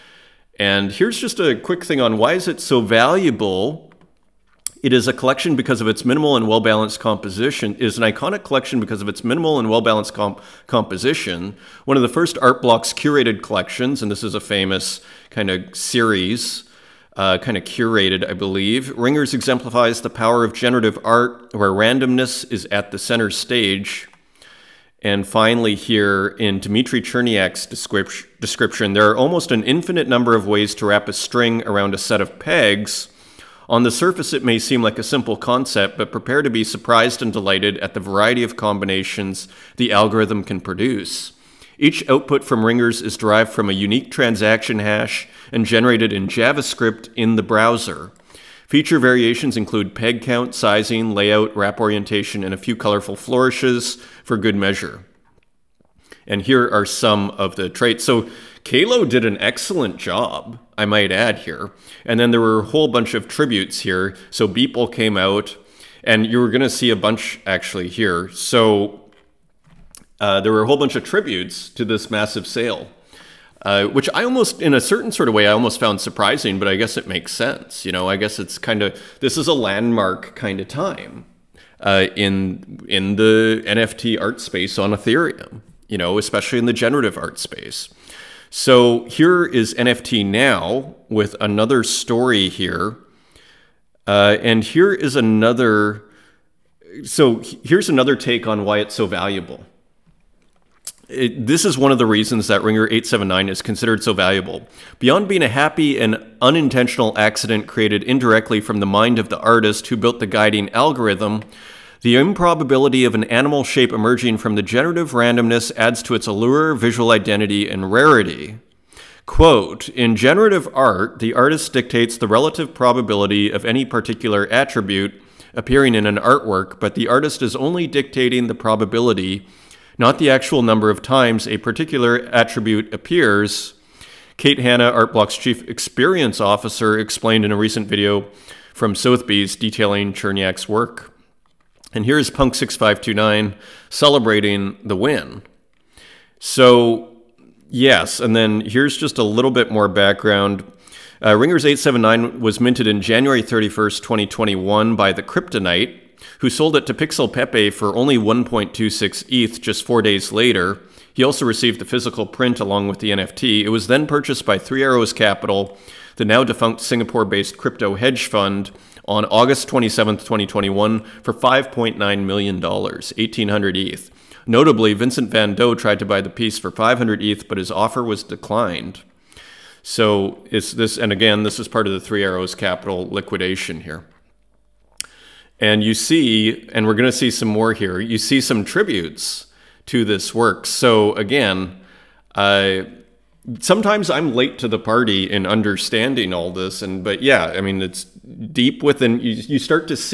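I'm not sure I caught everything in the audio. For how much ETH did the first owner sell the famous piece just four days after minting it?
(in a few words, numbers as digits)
1.26 ETH.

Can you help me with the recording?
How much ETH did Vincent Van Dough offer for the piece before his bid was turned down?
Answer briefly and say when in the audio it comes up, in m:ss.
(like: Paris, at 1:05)
500 ETH, at 2:56.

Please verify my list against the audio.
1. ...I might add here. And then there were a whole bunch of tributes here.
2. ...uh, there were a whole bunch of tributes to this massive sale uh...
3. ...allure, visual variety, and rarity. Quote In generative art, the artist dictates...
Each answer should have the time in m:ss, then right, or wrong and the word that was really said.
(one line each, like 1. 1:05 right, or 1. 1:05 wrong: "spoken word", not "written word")
1. 1:00 right
2. 1:10 right
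3. 1:56 wrong: "identity", not "variety".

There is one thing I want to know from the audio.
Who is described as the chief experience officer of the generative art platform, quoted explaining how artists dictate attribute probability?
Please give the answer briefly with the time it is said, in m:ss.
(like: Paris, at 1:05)
Kate Hanna, at 2:14.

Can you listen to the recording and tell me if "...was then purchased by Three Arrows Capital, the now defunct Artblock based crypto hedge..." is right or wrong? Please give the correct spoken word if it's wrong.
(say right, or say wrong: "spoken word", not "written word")
wrong: "Singapore", not "Artblock".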